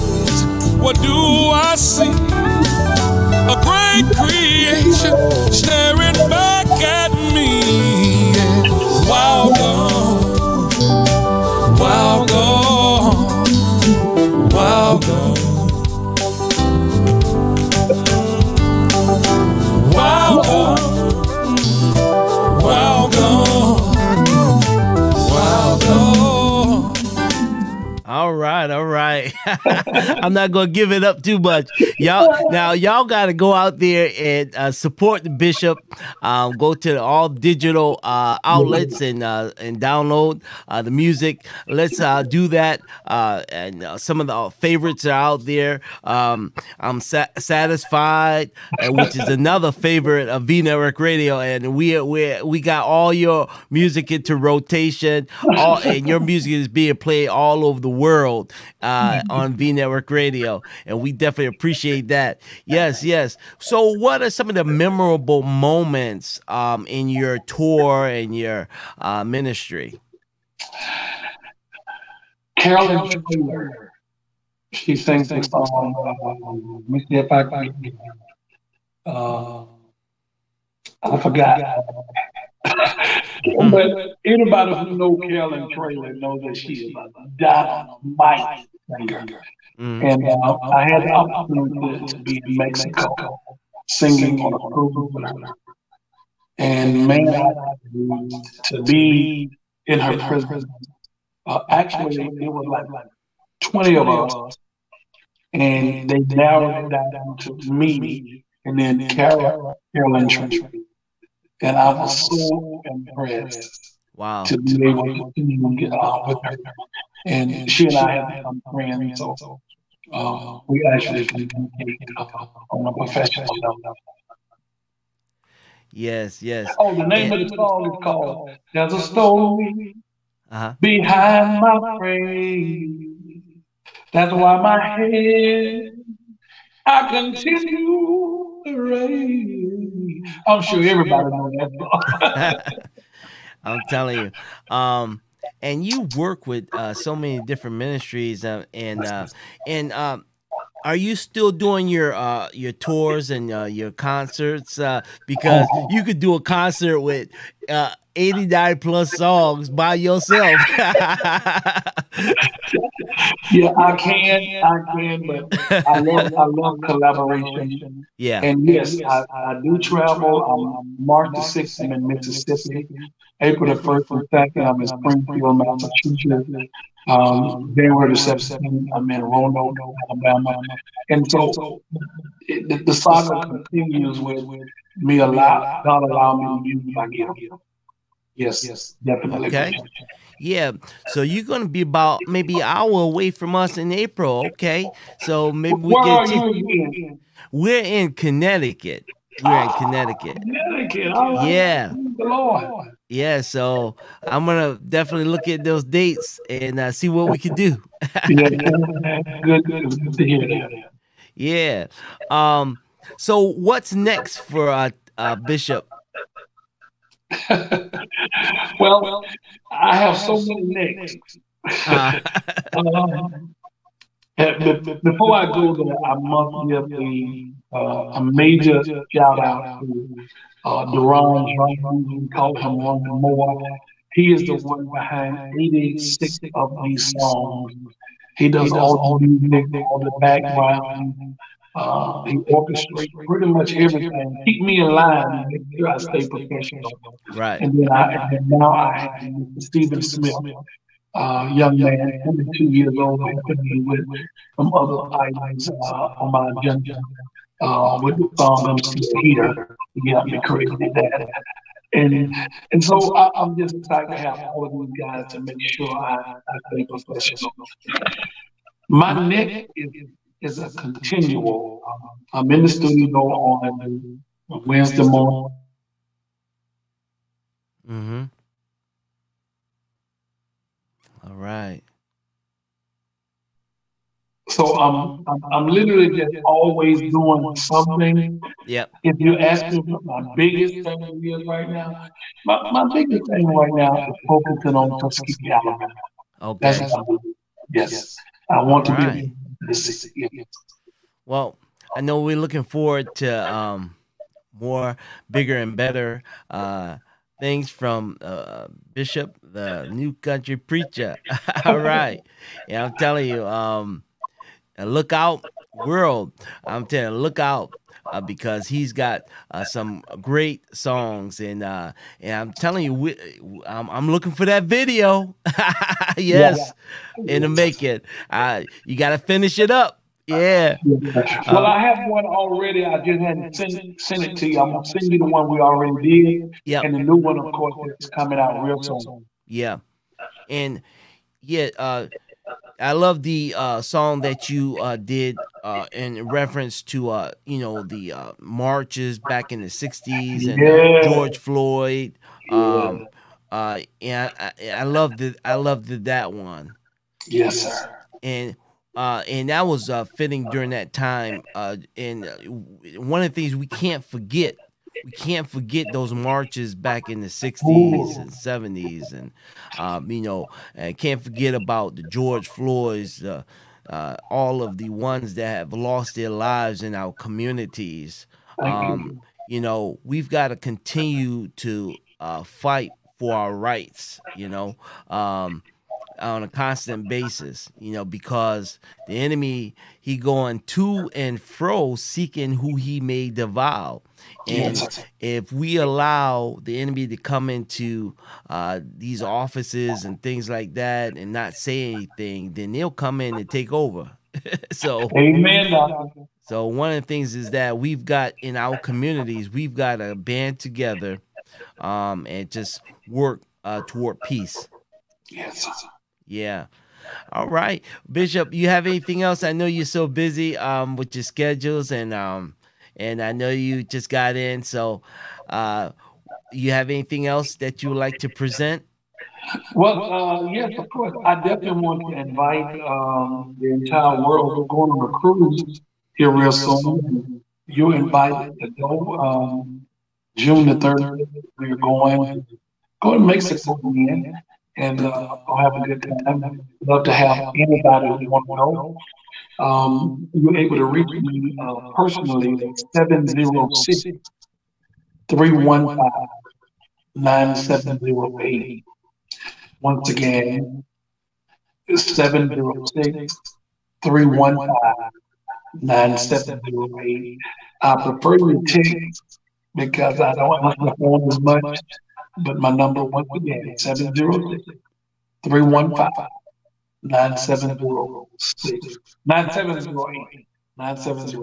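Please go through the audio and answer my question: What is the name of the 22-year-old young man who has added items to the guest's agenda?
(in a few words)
Stephen Smith.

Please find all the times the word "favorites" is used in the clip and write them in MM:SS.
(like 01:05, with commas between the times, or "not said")
00:44, 00:49.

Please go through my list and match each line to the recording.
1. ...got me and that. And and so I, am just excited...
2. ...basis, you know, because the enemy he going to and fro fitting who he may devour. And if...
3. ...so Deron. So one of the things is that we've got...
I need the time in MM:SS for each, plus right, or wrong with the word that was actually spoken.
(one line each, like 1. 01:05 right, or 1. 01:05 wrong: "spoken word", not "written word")
1. 04:20 right
2. 06:27 wrong: "seeking", not "fitting"
3. 06:44 wrong: "Amen", not "Deron".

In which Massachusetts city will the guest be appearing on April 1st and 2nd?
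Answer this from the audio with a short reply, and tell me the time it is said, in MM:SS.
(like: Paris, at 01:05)
Springfield, at 02:54.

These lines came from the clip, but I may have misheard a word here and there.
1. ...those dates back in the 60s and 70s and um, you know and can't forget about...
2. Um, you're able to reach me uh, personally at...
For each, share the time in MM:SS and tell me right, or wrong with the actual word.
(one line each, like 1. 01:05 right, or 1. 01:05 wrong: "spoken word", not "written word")
1. 06:05 wrong: "marches", not "dates"
2. 07:29 right.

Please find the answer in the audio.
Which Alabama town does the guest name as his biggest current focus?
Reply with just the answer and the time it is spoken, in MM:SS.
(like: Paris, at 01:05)
Tuskegee, at 04:55.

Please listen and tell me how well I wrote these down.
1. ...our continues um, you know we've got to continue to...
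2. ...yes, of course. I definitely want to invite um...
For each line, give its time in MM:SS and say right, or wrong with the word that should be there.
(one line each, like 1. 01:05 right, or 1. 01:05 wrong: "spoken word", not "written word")
1. 06:16 wrong: "communities", not "continues"
2. 07:10 right.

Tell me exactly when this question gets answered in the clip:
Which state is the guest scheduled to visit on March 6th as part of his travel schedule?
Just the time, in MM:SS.
02:52.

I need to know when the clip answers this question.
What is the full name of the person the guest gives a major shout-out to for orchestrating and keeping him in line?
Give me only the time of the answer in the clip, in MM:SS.
03:50.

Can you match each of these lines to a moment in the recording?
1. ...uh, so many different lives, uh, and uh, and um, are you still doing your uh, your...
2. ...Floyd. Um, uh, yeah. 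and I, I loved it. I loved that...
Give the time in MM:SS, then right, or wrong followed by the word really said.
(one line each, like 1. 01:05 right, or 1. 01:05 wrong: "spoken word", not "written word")
1. 02:26 wrong: "ministries", not "lives"
2. 05:51 right.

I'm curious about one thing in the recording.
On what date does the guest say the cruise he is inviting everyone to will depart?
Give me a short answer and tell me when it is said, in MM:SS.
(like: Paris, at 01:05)
June 3, at 07:20.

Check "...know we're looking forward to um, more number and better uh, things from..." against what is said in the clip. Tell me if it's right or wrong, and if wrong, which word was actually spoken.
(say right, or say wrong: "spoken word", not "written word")
wrong: "bigger", not "number".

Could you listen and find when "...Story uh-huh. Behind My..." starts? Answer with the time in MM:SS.
02:09.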